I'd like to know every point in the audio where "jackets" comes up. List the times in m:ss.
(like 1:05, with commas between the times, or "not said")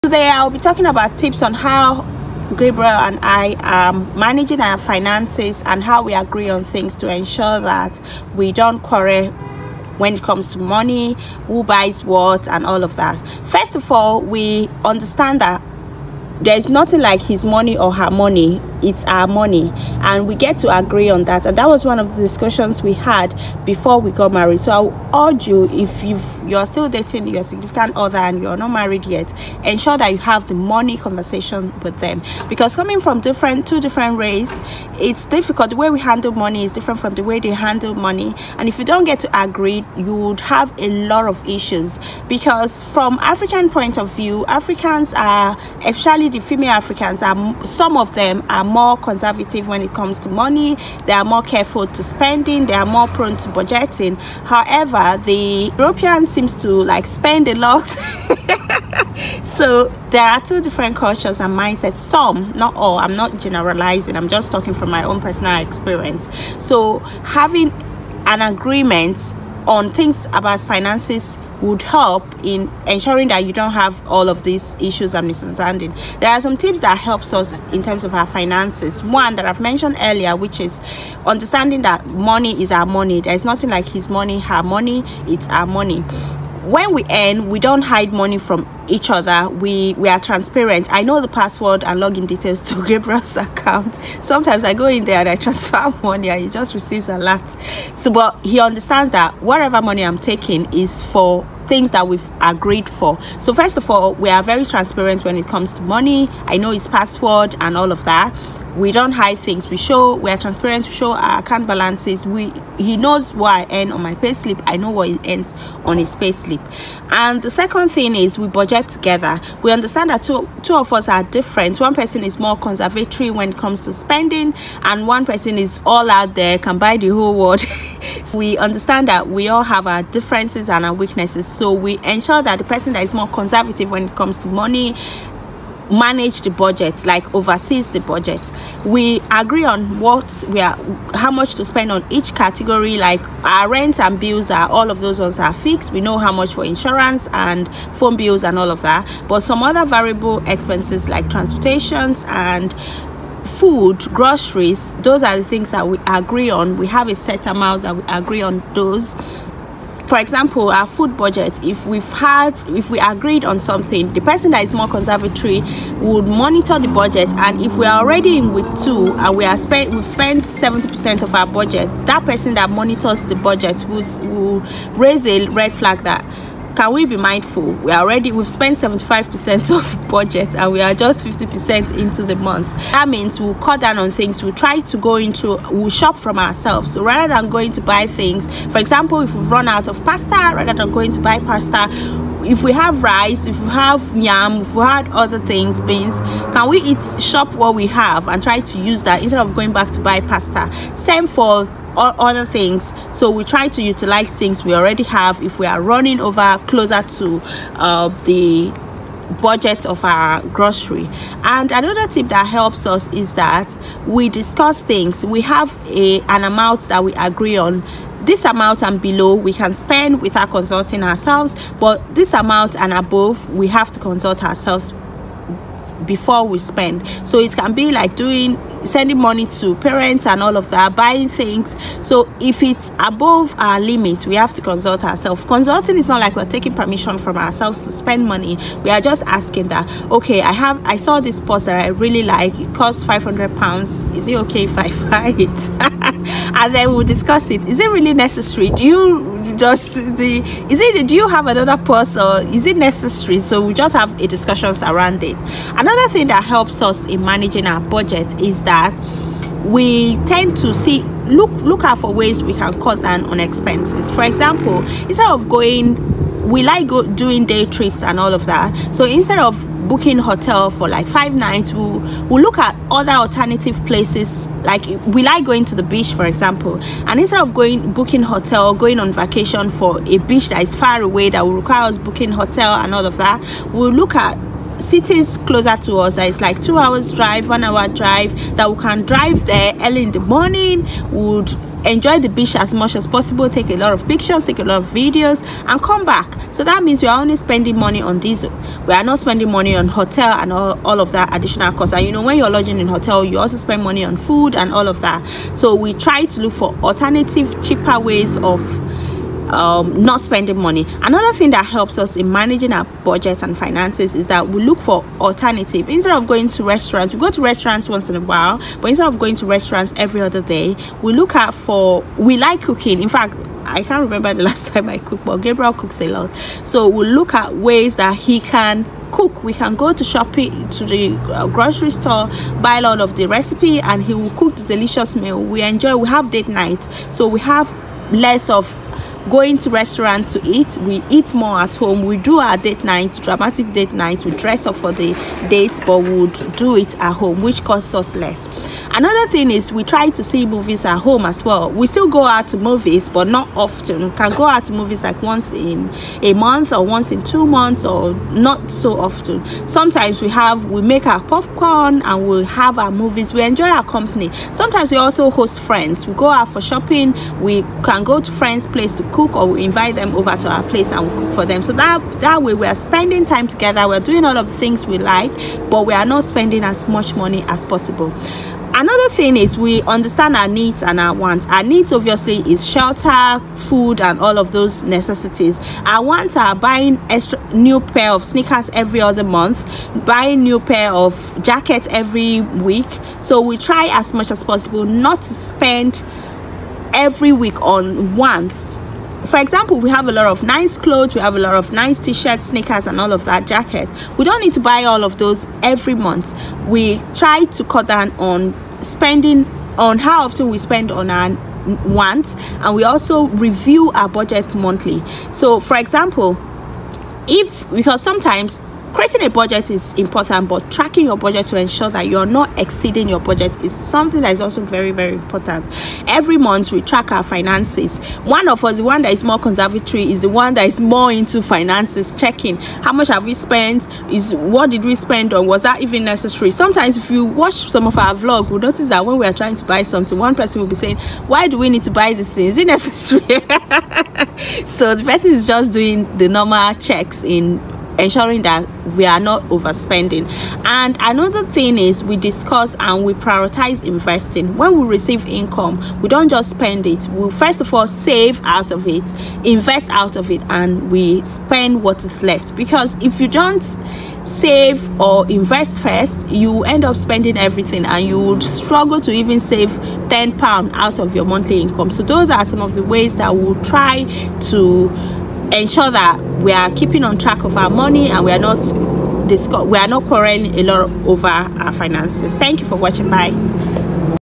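6:31, 6:43.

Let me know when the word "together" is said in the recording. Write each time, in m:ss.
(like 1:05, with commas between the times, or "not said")
1:58, 6:13.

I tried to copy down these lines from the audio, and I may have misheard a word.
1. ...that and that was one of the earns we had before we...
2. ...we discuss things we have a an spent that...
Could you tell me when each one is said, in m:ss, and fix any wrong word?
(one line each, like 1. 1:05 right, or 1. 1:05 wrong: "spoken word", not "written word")
1. 0:21 wrong: "discussions", not "earns"
2. 3:34 wrong: "amount", not "spent".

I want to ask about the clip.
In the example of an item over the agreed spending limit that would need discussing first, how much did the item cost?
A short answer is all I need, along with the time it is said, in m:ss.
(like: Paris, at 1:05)
500 pounds, at 4:03.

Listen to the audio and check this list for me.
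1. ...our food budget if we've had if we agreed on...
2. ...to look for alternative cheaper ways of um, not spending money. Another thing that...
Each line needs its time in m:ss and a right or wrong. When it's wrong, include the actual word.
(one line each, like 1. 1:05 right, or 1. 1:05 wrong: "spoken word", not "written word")
1. 2:40 right
2. 5:06 right.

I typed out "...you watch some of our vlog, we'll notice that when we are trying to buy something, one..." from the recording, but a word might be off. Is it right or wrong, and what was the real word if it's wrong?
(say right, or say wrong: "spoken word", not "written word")
right.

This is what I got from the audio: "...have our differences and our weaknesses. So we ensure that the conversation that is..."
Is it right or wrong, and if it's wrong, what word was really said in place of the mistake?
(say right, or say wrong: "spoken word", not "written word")
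wrong: "person", not "conversation".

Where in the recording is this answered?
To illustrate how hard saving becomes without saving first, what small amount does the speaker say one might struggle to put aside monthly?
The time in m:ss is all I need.
7:50.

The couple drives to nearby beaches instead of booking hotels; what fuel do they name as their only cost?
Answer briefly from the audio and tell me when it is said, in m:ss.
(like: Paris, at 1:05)
Diesel, at 4:58.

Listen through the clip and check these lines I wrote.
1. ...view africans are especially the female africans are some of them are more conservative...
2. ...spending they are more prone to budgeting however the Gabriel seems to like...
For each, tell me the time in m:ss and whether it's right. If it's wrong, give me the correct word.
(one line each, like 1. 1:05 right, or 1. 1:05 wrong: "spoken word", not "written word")
1. 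0:44 right
2. 0:52 wrong: "European", not "Gabriel".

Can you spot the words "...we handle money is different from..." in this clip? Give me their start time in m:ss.
0:35.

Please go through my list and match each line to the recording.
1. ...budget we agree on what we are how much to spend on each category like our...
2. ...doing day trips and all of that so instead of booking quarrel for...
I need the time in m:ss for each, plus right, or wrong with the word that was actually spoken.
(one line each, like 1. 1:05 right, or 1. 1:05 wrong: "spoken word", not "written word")
1. 2:17 right
2. 4:27 wrong: "hotel", not "quarrel".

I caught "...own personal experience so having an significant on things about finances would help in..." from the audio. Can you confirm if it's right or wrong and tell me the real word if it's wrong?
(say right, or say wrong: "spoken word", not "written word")
wrong: "agreement", not "significant".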